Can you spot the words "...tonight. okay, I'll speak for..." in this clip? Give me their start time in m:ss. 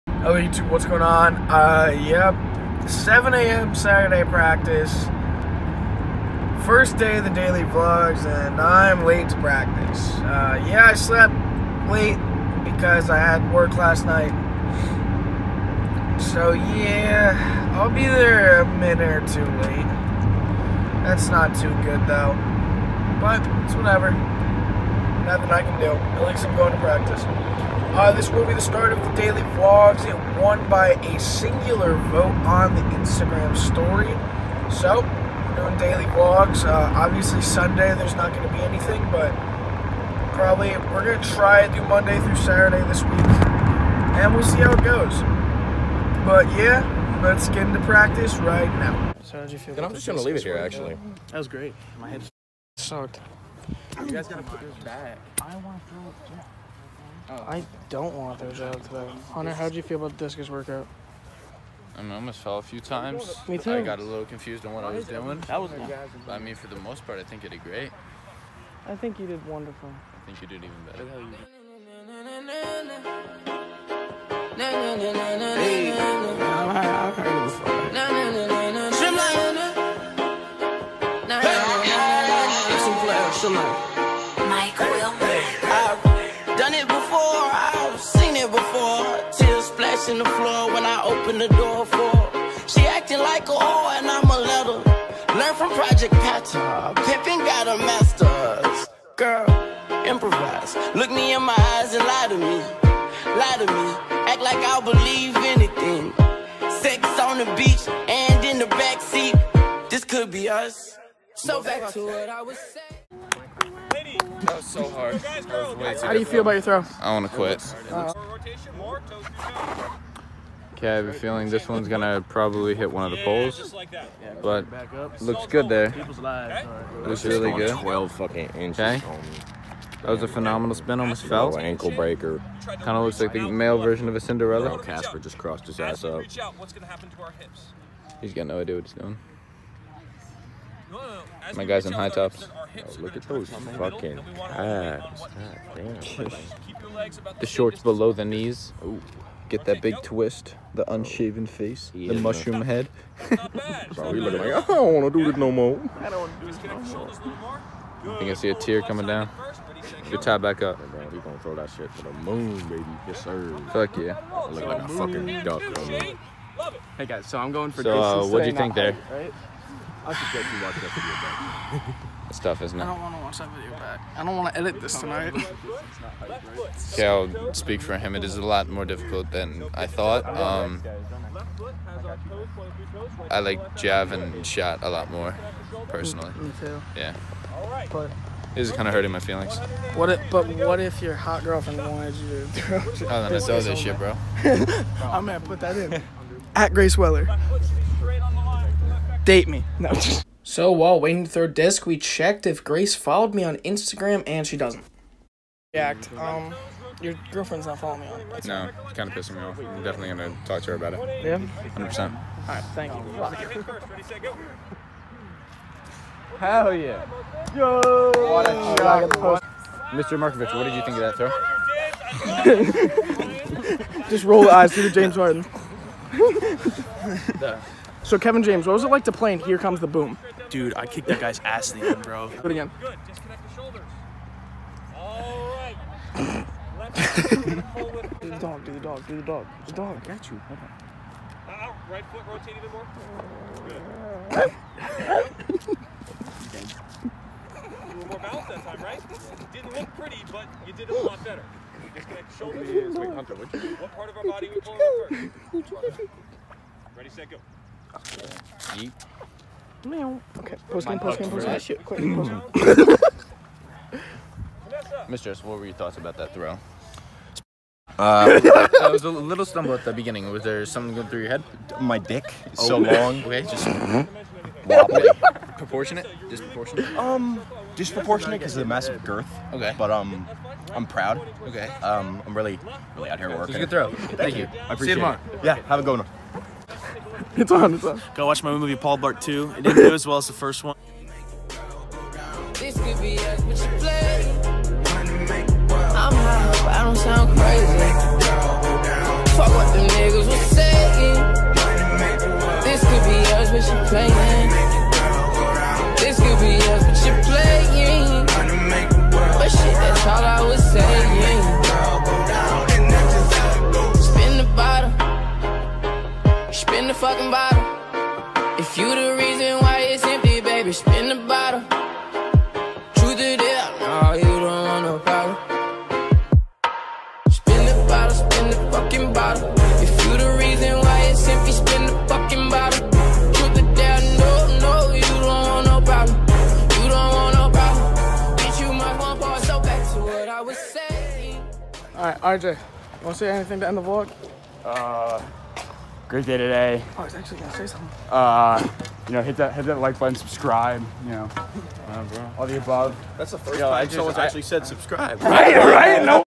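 2:54.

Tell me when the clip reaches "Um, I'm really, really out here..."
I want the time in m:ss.
4:41.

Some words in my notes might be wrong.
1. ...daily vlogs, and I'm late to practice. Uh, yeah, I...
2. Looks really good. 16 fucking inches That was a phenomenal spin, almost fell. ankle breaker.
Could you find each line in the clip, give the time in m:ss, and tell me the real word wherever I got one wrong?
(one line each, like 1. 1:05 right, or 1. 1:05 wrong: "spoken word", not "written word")
1. 0:07 right
2. 2:07 wrong: "12", not "16".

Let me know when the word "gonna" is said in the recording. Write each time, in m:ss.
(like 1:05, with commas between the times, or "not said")
2:41, 3:15, 3:30, 5:47.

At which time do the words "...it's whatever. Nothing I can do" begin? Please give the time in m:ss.
0:23.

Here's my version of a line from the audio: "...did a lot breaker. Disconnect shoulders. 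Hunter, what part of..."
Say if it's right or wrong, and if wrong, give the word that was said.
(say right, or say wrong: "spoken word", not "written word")
wrong: "better", not "breaker".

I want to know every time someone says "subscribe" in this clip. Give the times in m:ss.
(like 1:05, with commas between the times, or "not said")
5:50, 5:54.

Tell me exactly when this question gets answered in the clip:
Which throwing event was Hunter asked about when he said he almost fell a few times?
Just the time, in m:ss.
1:00.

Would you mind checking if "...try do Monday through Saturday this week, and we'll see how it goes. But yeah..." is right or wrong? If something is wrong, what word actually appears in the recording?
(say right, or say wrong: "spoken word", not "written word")
right.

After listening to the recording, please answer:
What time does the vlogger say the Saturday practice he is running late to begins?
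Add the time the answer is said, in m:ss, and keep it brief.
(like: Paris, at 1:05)
7 a.m., at 0:02.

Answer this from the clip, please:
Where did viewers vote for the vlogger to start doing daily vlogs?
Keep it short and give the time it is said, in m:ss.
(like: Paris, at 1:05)
Instagram story, at 0:32.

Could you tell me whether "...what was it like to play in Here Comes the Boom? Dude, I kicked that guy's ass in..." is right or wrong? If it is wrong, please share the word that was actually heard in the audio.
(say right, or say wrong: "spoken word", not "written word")
right.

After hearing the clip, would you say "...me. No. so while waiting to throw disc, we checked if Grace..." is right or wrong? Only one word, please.
right.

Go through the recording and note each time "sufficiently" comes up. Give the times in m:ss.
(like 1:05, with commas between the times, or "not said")
not said.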